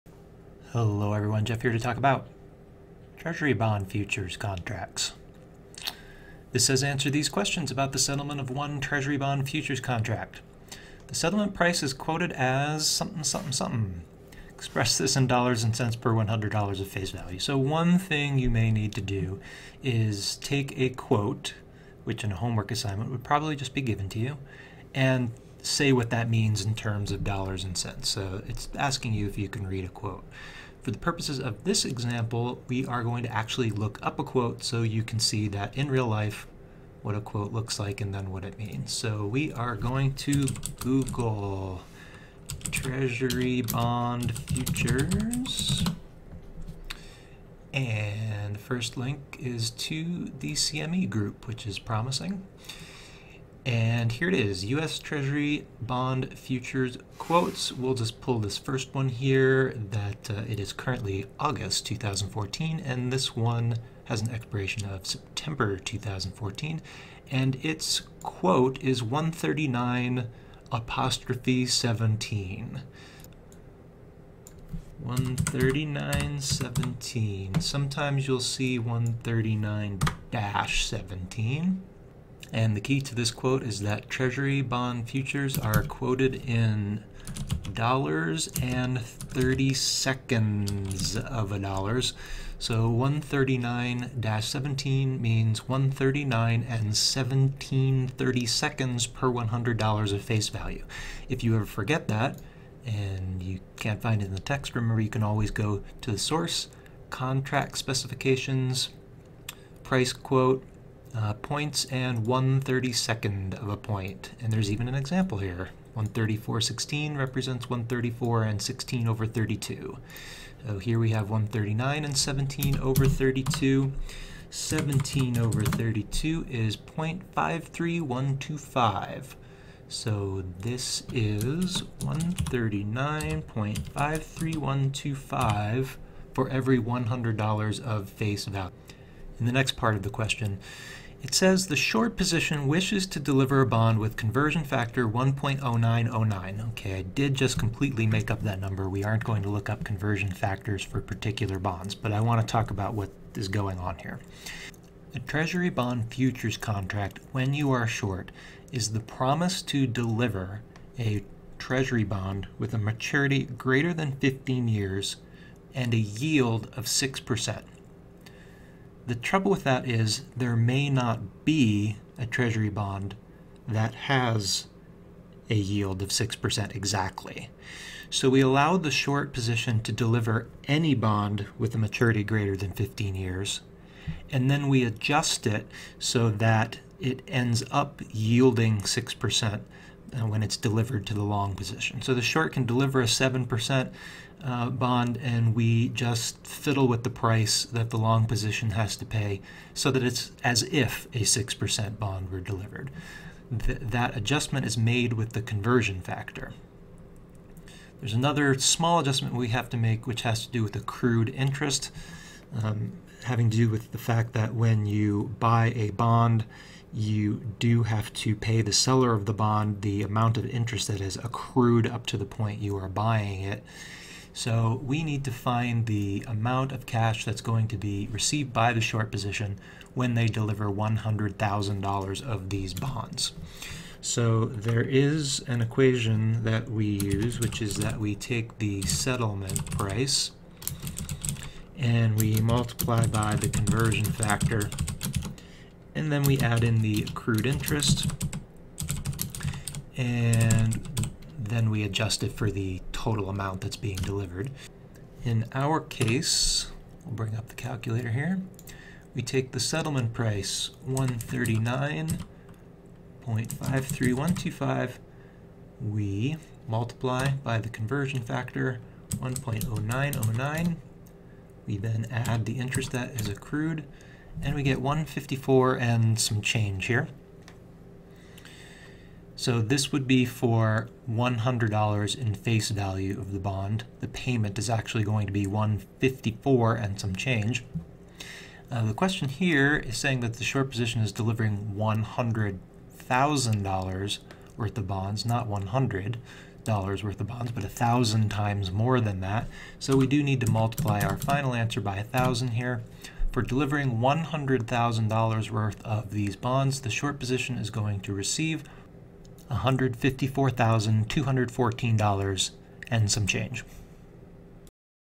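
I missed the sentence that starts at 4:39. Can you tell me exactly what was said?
So this would be for $100 in face value of the bond.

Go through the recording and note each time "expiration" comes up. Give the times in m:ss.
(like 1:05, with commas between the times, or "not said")
1:04.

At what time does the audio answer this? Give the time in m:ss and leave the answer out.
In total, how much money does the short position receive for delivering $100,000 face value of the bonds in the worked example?
5:09.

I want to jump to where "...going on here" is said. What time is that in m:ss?
2:33.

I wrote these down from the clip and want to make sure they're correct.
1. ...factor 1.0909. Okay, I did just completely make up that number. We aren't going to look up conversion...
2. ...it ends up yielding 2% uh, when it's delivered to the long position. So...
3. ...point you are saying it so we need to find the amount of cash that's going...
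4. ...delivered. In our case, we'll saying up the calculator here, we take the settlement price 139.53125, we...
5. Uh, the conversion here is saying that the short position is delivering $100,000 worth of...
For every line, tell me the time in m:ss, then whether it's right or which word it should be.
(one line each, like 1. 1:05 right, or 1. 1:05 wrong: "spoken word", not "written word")
1. 2:24 right
2. 3:07 wrong: "6", not "2"
3. 3:42 wrong: "buying", not "saying"
4. 4:13 wrong: "bring", not "saying"
5. 4:48 wrong: "question", not "conversion".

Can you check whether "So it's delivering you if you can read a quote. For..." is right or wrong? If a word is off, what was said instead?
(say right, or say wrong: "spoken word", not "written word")
wrong: "asking", not "delivering".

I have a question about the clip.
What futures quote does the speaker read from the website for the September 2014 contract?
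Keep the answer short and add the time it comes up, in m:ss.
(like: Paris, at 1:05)
139-17, at 1:09.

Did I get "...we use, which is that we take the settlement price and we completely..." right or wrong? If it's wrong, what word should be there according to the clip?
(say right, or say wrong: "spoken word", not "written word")
wrong: "multiply", not "completely".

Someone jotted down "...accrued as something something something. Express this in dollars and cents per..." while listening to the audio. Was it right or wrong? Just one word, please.
wrong.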